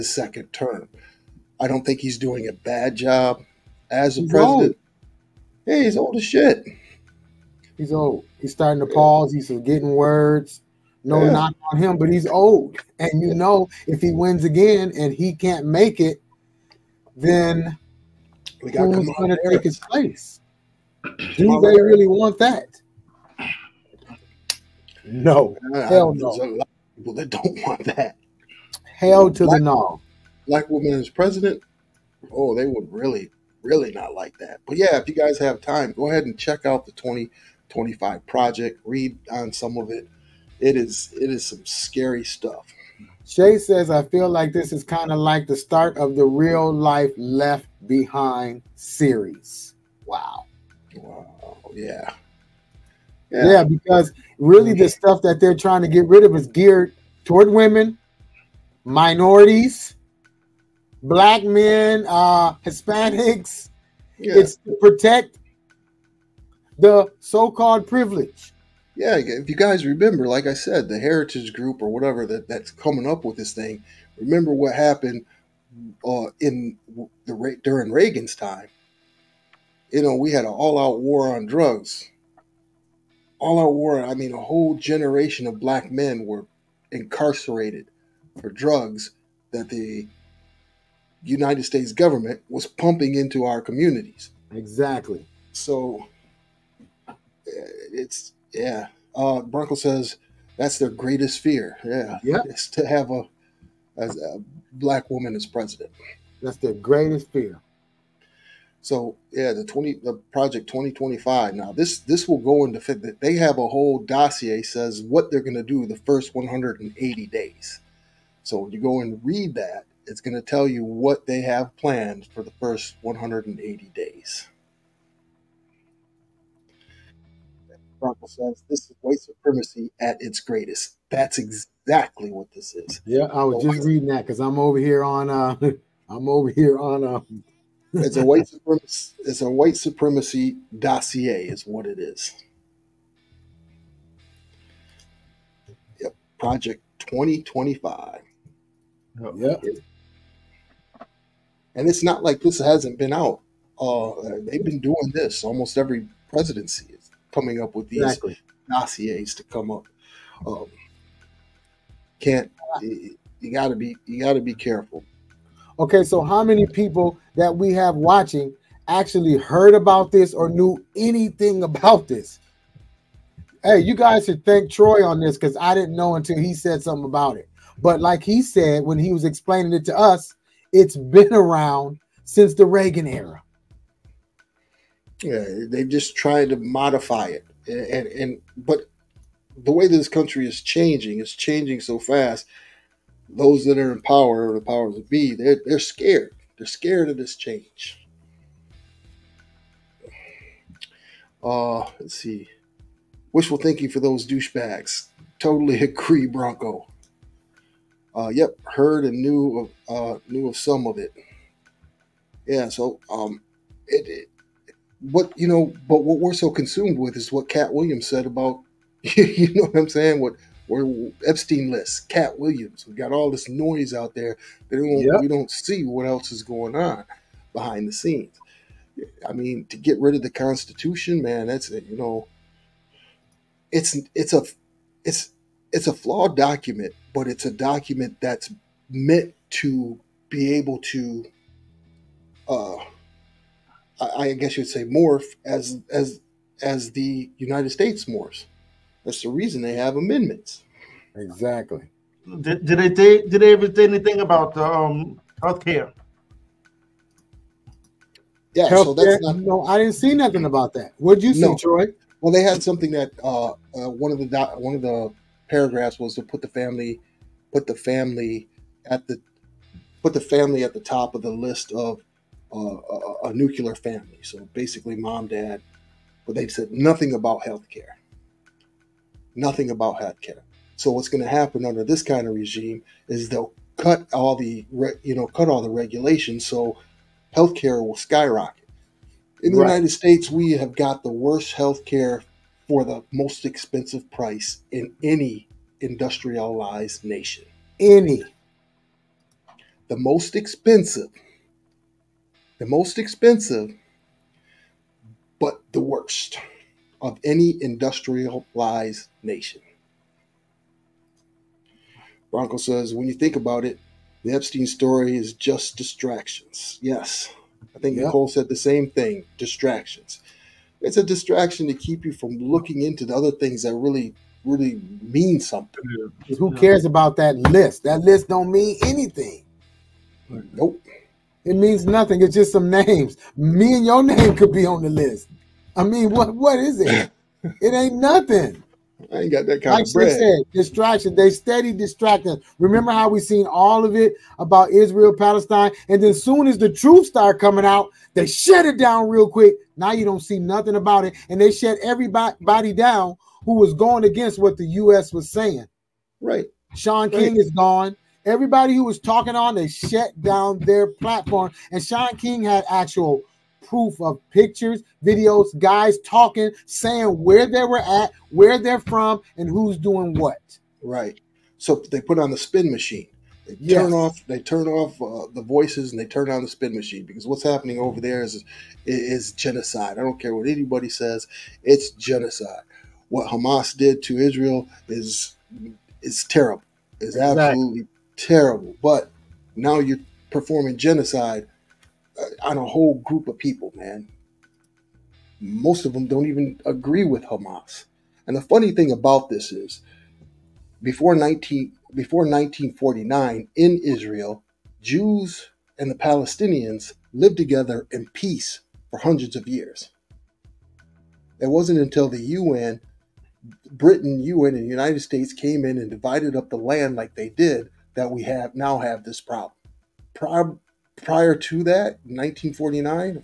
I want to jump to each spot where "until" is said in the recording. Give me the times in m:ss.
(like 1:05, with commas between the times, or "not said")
2:56, 6:51.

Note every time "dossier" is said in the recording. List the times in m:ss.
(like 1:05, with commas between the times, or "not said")
1:54, 2:20, 2:38.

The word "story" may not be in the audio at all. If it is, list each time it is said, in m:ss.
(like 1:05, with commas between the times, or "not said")
5:14.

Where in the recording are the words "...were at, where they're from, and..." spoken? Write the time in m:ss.
6:07.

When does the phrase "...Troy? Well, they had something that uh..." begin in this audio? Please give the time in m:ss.
4:21.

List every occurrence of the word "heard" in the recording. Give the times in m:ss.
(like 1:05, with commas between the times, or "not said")
2:49, 3:28.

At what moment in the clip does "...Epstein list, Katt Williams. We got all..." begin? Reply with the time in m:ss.
3:41.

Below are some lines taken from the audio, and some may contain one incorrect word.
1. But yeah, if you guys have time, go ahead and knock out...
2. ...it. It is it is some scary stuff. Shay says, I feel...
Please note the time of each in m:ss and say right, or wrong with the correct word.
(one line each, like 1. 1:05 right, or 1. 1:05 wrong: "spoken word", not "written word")
1. 0:34 wrong: "check", not "knock"
2. 0:39 right.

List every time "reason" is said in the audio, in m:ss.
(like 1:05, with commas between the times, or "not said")
4:09.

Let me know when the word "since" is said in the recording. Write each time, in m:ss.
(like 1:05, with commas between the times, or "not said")
3:02.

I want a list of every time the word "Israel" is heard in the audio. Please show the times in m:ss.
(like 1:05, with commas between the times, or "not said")
5:44, 6:24, 6:43.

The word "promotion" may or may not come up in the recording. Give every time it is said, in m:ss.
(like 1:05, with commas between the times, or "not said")
not said.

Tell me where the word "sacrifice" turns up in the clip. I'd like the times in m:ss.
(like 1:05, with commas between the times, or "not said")
not said.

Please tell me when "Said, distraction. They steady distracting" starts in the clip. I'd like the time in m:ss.
5:40.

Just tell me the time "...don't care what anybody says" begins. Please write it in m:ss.
6:20.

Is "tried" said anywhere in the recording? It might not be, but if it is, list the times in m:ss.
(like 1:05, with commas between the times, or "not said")
3:06.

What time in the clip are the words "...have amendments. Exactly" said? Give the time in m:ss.
4:09.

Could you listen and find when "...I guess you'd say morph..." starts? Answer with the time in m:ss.
4:04.